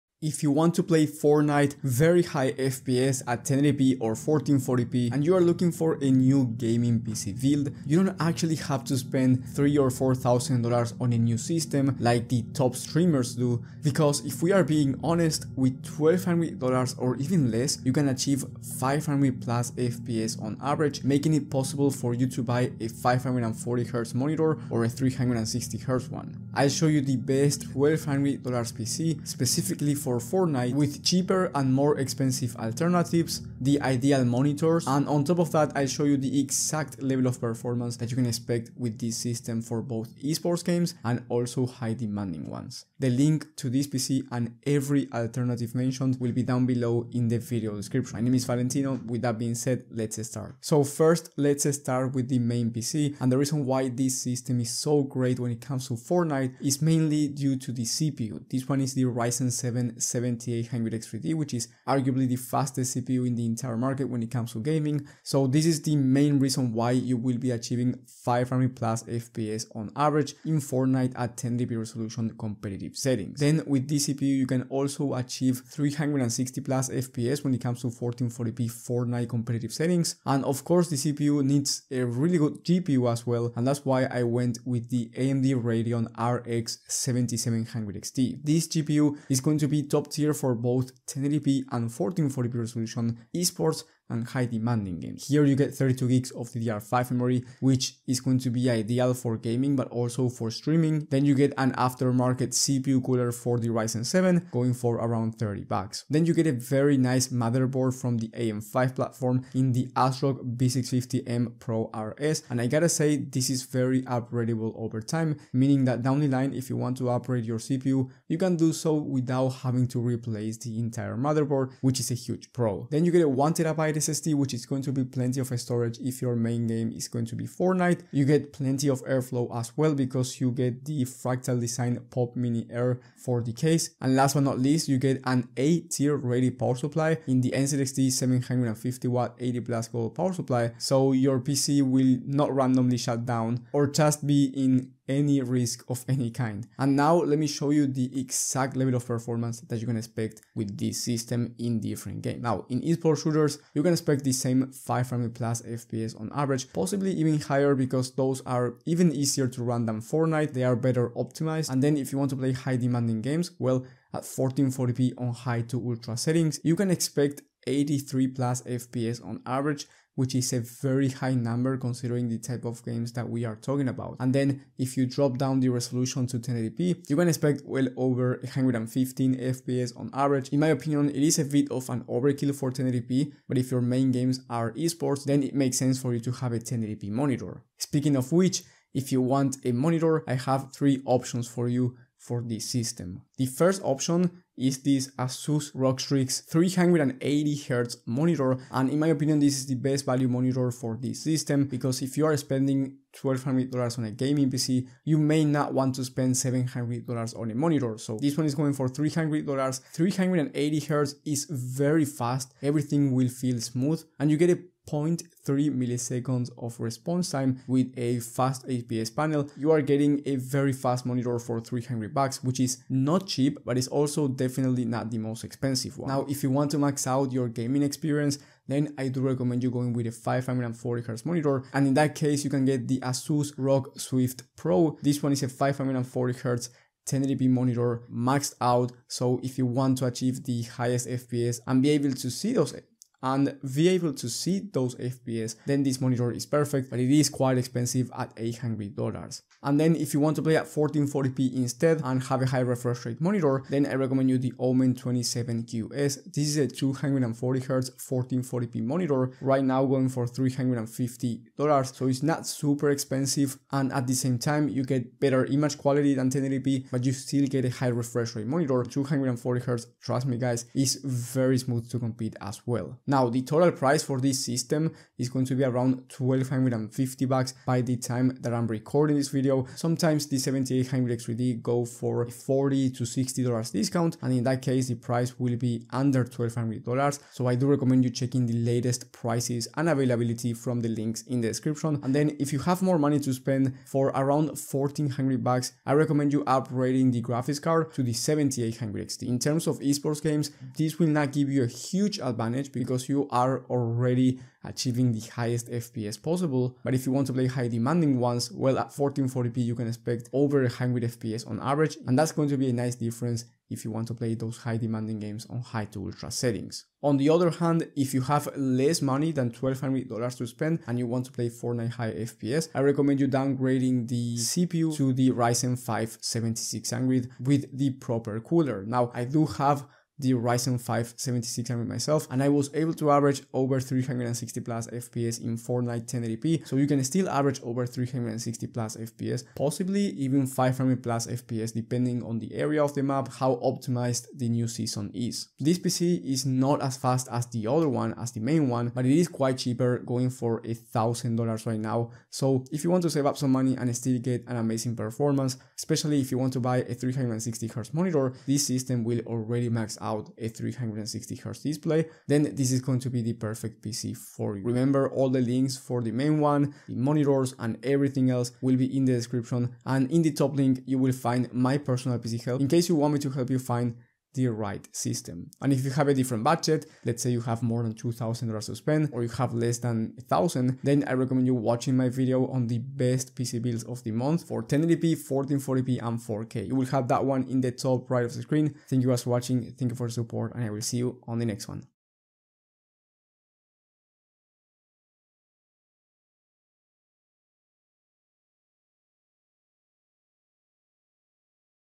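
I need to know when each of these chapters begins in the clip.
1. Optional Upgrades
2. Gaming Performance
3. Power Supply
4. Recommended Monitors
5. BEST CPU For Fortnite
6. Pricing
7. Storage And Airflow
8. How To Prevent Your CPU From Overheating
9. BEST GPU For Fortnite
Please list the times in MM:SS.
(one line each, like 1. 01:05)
1. 04:54
2. 02:43
3. 02:18
4. 03:13
5. 00:53
6. 04:36
7. 02:05
8. 01:43
9. 01:24.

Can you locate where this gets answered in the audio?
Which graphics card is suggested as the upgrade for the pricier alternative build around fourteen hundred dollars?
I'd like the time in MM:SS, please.
04:58.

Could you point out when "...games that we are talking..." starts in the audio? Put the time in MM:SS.
02:52.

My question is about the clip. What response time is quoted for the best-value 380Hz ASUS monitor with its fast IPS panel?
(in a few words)
0.3 milliseconds.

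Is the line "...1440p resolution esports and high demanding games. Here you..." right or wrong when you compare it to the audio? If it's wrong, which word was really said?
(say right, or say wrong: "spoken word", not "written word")
right.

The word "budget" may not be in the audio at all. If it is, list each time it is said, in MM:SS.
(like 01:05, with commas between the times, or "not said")
06:16.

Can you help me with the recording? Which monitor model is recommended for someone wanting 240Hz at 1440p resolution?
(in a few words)
Omen 27QS.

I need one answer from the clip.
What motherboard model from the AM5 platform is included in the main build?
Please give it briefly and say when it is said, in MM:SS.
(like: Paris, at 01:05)
ASRock B650M Pro RS, at 01:49.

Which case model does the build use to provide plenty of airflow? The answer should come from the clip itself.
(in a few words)
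Fractal Design Pop Mini Air.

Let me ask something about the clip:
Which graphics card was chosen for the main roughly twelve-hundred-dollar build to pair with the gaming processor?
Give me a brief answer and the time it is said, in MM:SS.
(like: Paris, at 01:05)
AMD Radeon RX 7700 XT, at 01:25.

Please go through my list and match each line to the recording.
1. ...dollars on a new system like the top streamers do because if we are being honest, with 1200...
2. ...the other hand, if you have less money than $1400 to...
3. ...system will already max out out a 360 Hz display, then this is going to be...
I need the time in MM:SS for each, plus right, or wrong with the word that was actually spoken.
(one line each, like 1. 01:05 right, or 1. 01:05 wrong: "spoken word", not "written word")
1. 00:10 right
2. 05:17 wrong: "1200", not "1400"
3. 05:58 right.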